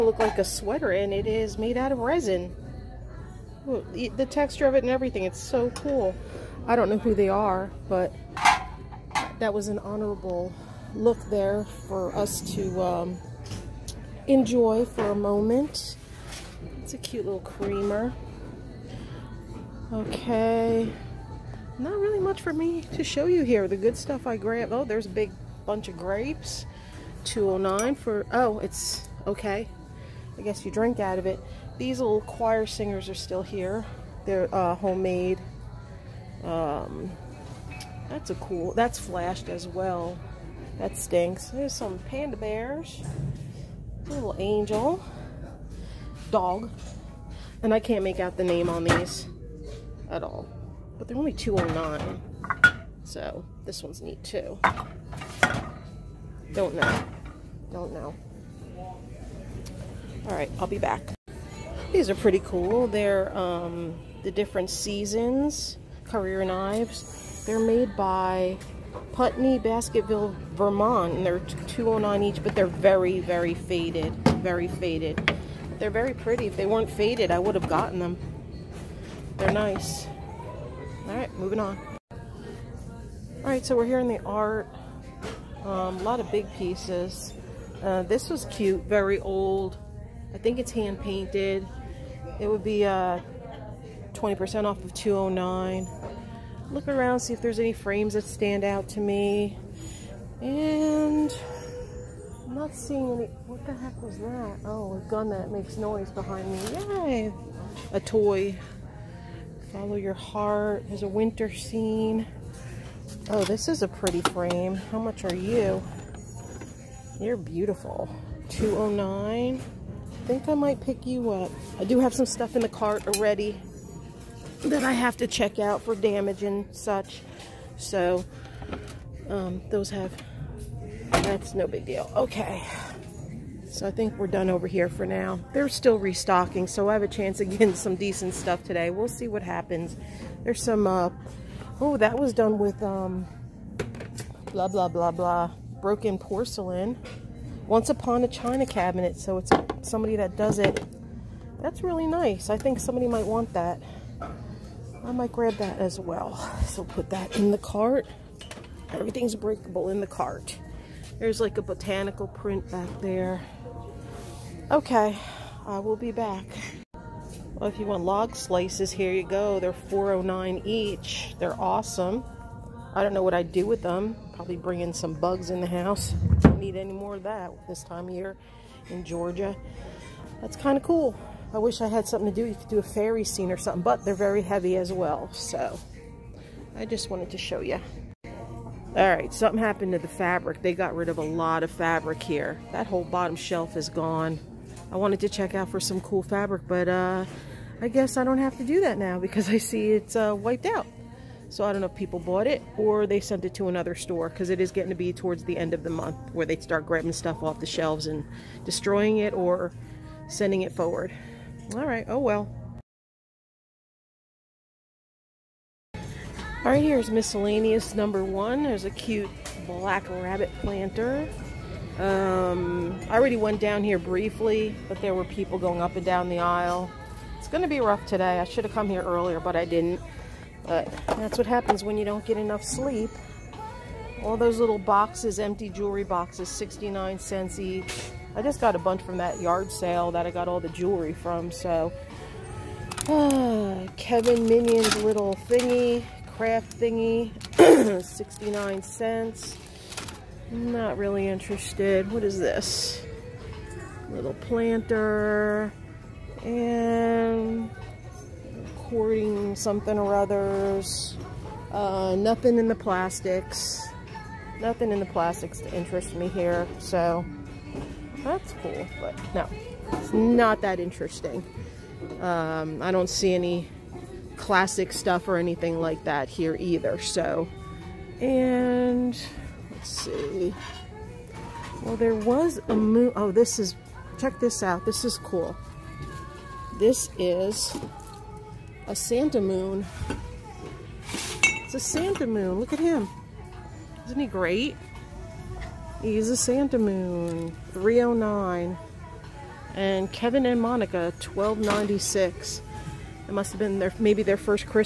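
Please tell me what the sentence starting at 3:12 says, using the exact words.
That whole bottom shelf is gone.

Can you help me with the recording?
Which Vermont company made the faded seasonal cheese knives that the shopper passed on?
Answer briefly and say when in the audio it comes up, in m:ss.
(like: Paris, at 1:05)
Putney Basketville, at 1:09.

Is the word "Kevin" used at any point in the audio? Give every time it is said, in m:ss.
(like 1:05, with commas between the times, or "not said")
4:03, 5:00.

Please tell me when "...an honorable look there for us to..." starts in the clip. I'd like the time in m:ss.
0:09.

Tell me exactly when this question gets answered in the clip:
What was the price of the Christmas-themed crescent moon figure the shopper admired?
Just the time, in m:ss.
4:57.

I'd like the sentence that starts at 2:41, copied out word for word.
There's like a botanical print back there.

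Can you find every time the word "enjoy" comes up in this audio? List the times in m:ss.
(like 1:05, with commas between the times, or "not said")
0:14.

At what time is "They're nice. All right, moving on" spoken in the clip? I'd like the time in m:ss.
1:19.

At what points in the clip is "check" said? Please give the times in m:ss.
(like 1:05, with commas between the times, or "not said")
2:05, 3:15, 4:44.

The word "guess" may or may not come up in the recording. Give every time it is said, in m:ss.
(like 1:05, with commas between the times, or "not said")
0:30, 3:17.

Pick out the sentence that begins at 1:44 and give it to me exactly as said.
Oh, a gun that makes noise behind me.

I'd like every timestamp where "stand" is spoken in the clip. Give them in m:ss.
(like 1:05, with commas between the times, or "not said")
1:38.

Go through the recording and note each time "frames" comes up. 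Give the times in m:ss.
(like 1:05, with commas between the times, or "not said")
1:37, 1:54.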